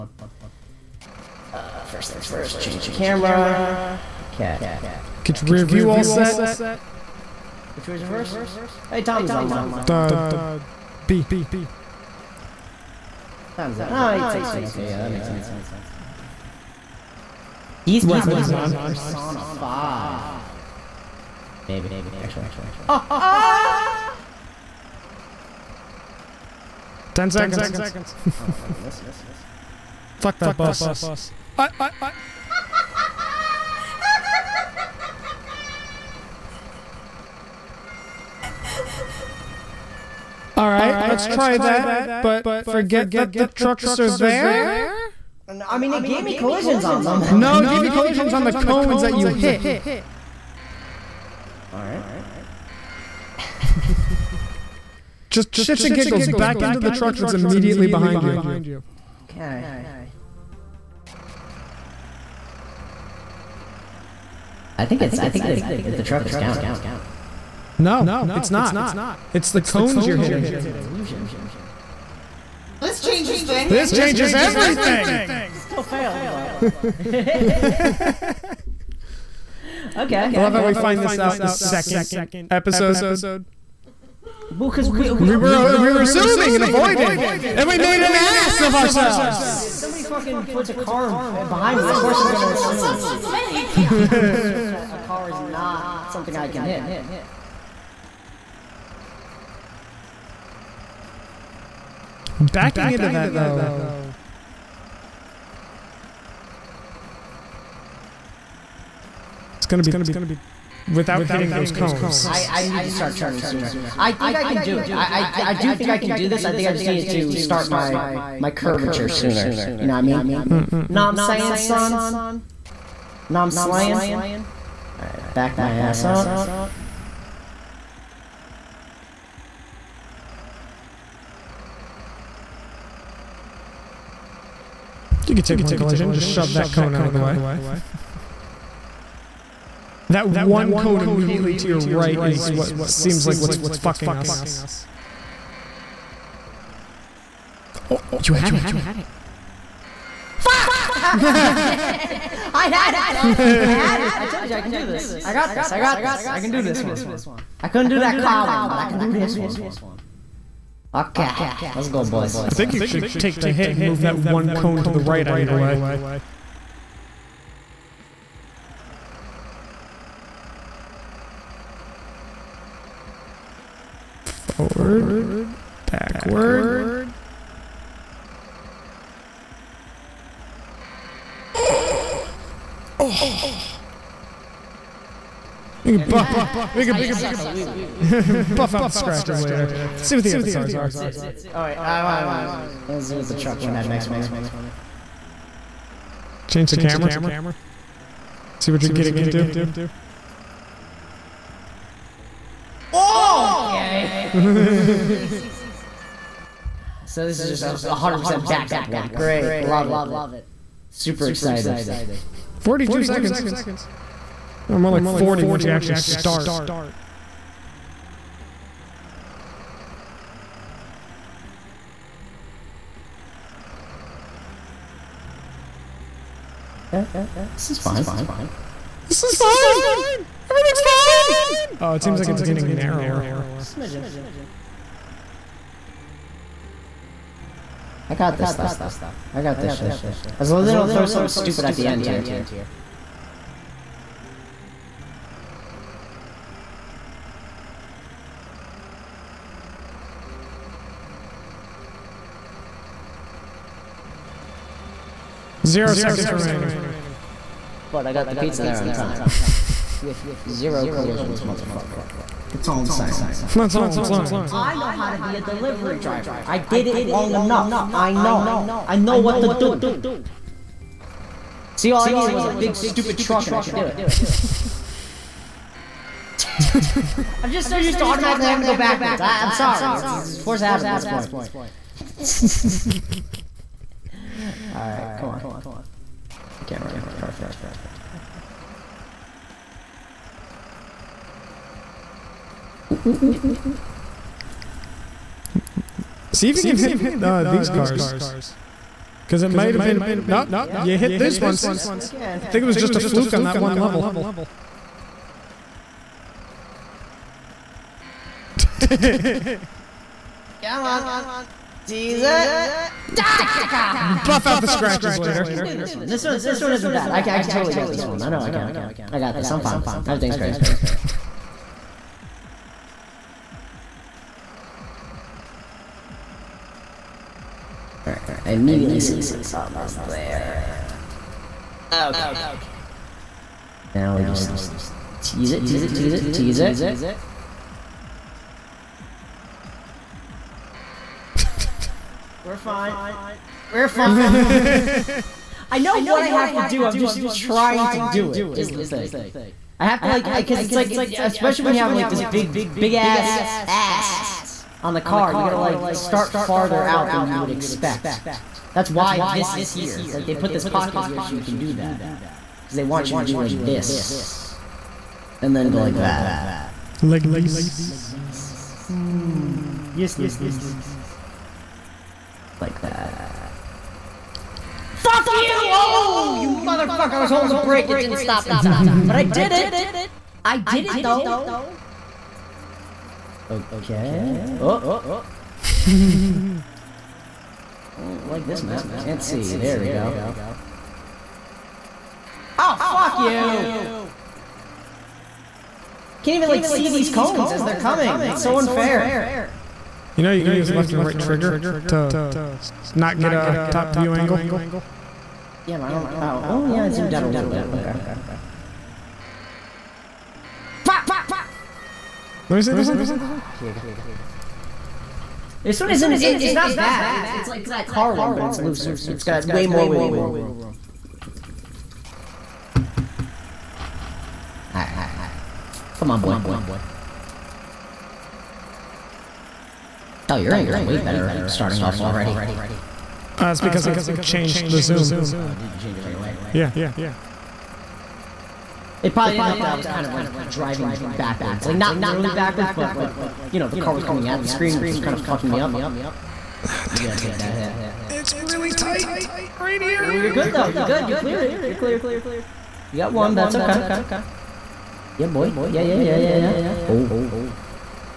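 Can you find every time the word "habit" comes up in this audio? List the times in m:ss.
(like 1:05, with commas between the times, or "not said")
4:40.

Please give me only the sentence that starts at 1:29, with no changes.
Dude, if somebody fucking puts a car uh, behind me, of course I'm gonna assume.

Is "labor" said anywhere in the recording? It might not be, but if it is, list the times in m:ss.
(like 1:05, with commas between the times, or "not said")
not said.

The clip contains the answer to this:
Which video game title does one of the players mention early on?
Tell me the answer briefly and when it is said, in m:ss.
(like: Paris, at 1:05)
Persona 5, at 0:18.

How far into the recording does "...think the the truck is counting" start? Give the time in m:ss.
1:05.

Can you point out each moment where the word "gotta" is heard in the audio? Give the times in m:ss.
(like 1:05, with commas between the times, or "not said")
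5:55, 7:27.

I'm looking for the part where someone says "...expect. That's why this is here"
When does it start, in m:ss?
5:57.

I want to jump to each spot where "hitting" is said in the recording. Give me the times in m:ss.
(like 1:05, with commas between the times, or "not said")
1:10, 1:51.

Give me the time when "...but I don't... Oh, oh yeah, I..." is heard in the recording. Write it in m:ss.
6:45.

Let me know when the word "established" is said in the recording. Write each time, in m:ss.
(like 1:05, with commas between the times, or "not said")
not said.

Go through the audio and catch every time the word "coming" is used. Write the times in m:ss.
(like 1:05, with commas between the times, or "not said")
6:37, 7:24.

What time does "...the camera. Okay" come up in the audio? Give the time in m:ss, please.
0:02.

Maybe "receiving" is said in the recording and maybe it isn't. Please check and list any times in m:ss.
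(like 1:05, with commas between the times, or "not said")
not said.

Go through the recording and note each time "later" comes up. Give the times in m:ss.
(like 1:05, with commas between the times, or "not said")
3:09, 5:15.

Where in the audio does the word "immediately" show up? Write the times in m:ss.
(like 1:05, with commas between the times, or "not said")
0:57, 2:21, 5:28.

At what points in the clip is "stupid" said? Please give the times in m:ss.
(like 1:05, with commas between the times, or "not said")
4:01, 4:32.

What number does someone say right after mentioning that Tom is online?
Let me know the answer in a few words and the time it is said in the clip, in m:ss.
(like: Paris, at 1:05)
816, at 0:14.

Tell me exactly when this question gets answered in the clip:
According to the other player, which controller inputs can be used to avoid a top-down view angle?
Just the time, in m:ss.
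6:40.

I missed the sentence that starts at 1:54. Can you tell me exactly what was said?
I, I, I do think I can do this.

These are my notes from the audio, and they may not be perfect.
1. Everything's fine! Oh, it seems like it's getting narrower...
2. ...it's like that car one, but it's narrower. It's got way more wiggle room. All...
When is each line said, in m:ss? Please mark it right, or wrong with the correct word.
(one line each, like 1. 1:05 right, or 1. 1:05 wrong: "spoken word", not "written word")
1. 3:50 right
2. 6:57 wrong: "looser", not "narrower".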